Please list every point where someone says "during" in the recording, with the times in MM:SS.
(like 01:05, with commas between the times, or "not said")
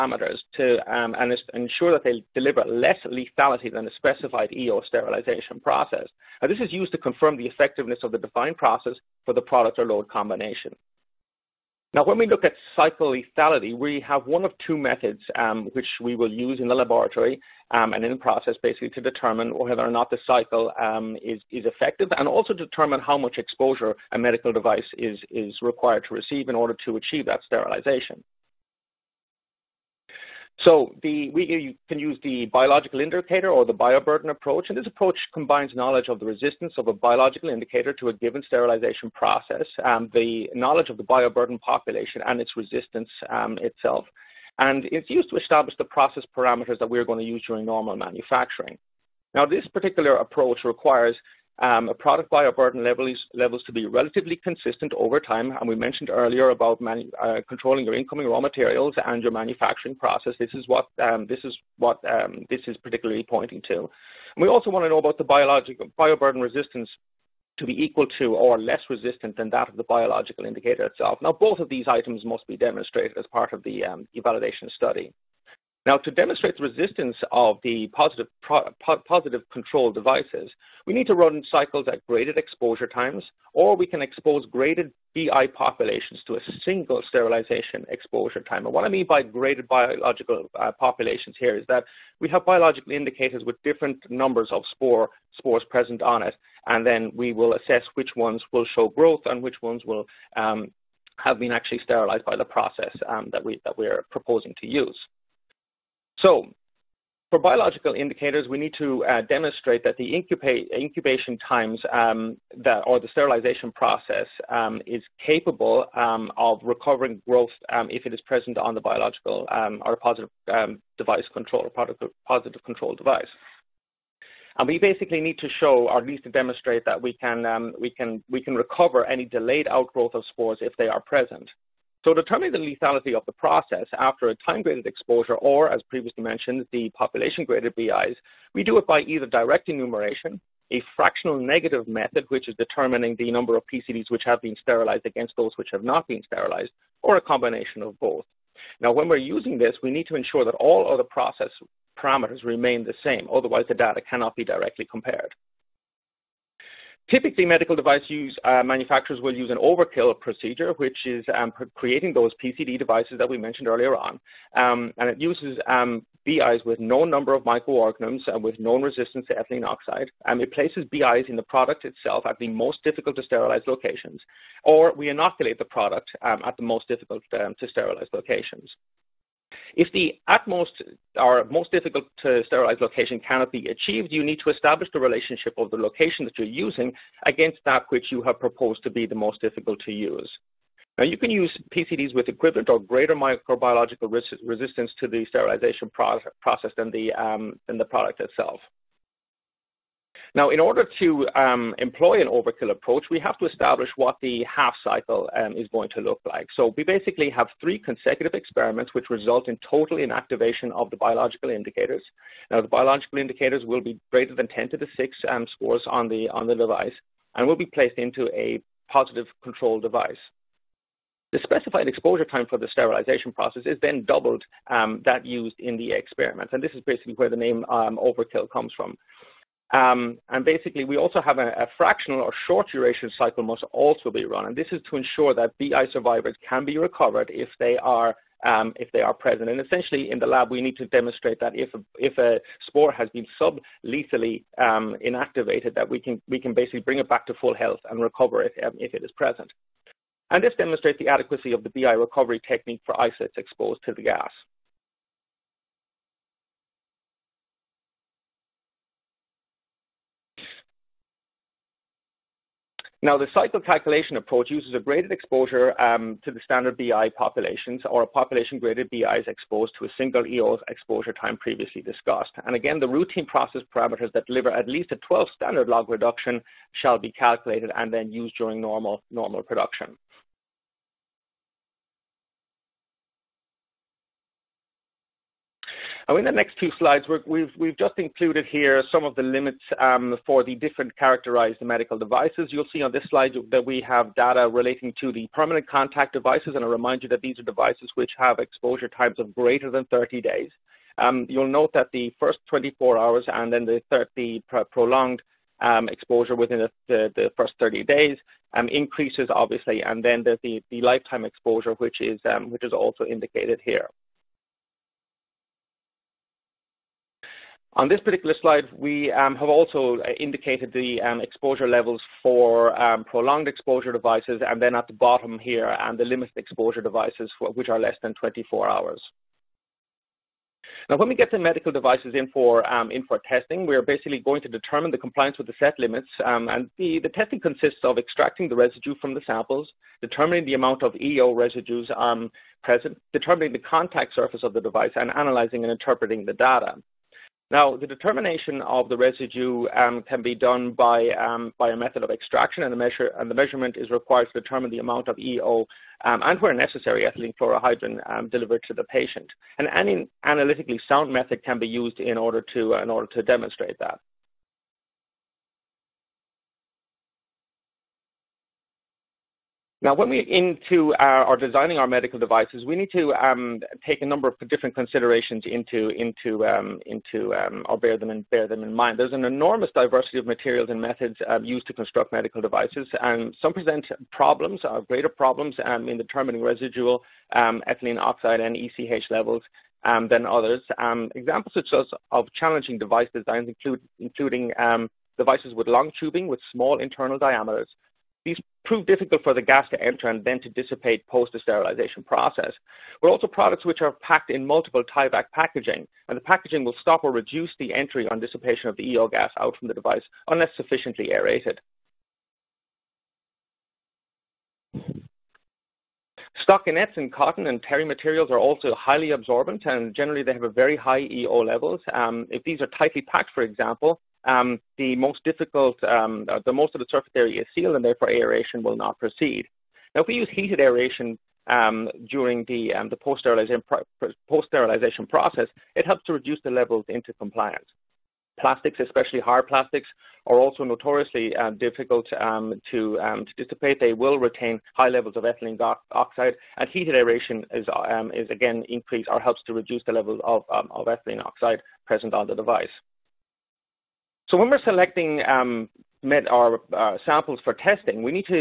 00:47, 04:38, 07:12.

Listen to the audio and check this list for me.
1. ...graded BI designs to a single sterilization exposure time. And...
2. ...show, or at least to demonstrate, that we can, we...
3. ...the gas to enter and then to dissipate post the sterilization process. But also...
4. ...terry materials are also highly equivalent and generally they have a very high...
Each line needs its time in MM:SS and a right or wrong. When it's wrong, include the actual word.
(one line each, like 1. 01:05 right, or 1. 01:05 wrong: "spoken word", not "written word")
1. 01:24 wrong: "populations", not "designs"
2. 02:05 right
3. 06:39 right
4. 06:57 wrong: "absorbent", not "equivalent".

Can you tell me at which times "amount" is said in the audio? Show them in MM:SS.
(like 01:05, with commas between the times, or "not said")
05:40, 05:54.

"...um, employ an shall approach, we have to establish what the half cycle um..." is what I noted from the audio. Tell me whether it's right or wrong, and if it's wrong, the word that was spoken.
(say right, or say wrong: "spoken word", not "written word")
wrong: "overkill", not "shall".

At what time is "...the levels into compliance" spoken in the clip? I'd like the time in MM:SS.
07:16.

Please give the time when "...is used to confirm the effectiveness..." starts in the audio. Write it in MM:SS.
00:06.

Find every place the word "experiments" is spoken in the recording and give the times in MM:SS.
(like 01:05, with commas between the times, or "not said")
03:28, 03:45.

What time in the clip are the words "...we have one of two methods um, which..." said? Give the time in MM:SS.
00:13.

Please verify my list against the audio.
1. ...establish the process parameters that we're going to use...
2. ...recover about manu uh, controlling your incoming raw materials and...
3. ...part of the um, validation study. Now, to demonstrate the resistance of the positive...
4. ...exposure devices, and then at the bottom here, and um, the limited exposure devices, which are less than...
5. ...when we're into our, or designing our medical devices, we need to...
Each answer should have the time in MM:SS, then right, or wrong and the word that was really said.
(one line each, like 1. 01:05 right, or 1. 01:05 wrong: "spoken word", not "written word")
1. 00:45 right
2. 00:56 wrong: "earlier", not "recover"
3. 01:13 right
4. 05:23 right
5. 06:09 right.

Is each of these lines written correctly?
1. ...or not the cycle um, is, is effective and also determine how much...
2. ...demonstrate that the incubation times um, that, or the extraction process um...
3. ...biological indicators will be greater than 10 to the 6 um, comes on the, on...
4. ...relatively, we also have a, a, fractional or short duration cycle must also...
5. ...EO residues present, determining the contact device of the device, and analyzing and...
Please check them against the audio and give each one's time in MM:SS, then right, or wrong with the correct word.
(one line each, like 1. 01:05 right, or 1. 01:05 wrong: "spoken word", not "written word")
1. 00:19 right
2. 01:49 wrong: "sterilization", not "extraction"
3. 03:32 wrong: "spores", not "comes"
4. 03:50 wrong: "basically", not "relatively"
5. 05:40 wrong: "surface", not "device".